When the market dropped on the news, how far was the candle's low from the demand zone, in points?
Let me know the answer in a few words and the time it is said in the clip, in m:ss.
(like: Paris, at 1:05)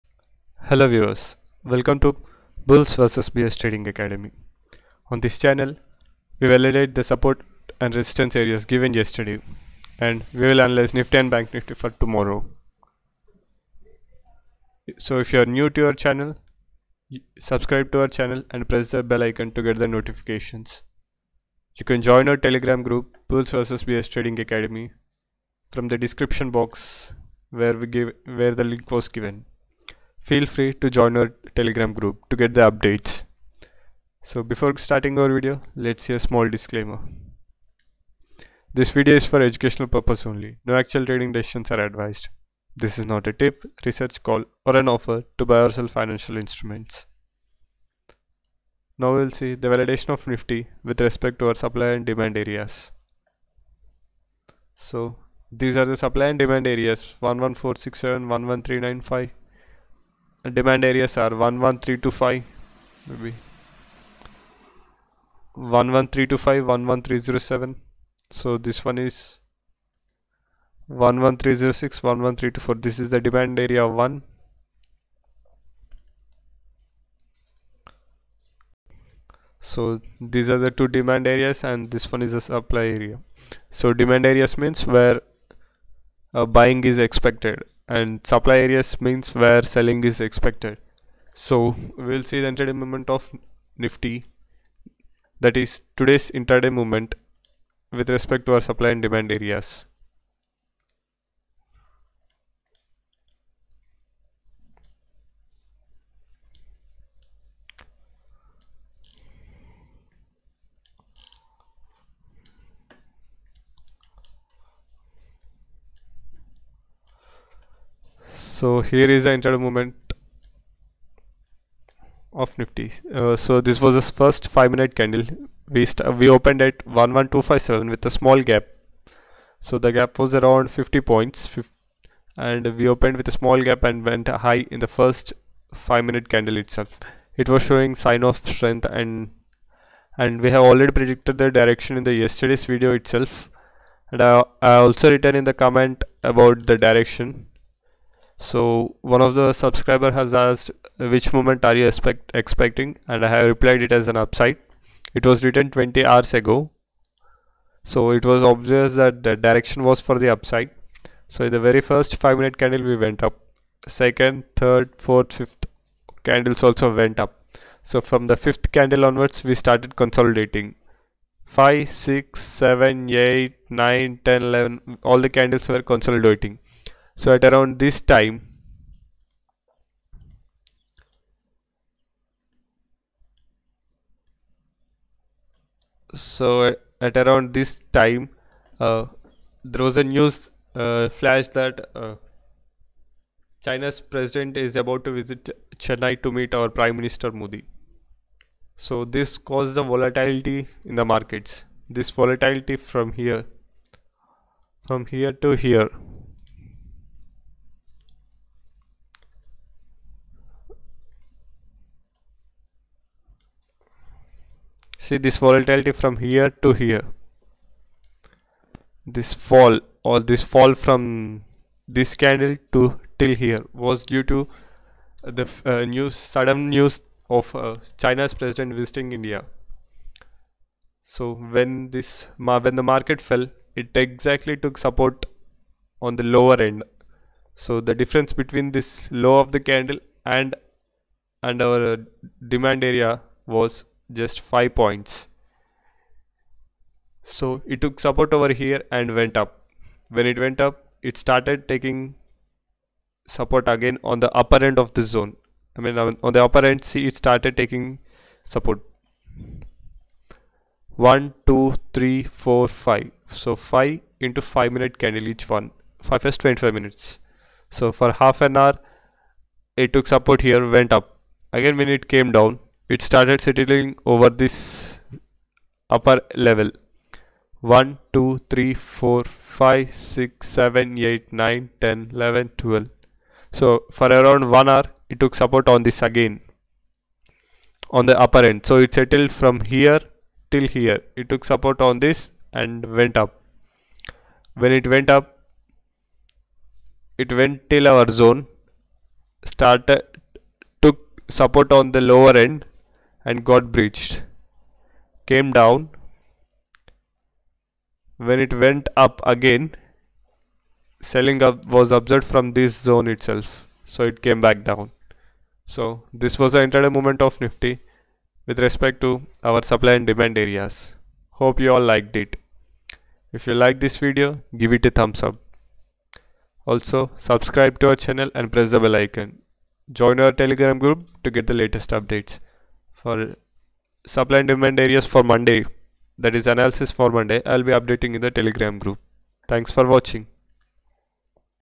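5, at 4:04.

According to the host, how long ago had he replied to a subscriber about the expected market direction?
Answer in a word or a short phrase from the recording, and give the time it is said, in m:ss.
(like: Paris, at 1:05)
20 hours, at 2:35.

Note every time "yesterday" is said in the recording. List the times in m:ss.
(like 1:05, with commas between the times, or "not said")
0:08, 2:22.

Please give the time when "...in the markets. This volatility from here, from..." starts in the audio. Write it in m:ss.
3:20.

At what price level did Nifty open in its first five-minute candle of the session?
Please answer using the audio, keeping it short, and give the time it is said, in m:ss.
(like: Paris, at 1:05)
11257, at 2:06.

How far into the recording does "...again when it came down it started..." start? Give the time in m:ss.
4:31.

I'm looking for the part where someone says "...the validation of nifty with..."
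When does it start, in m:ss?
0:49.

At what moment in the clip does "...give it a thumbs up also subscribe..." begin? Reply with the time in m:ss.
5:24.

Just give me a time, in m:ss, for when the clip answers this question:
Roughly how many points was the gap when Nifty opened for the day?
2:10.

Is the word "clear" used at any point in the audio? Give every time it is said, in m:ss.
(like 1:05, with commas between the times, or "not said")
not said.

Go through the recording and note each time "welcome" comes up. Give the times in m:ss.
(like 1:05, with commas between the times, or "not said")
0:01.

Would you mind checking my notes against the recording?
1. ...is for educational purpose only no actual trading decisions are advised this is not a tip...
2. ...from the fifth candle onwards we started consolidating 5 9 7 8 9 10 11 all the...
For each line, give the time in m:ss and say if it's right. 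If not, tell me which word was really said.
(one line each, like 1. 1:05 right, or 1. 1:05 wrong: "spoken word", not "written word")
1. 0:39 right
2. 2:48 wrong: "6", not "9".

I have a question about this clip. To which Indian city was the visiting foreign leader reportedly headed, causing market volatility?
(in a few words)
Chennai.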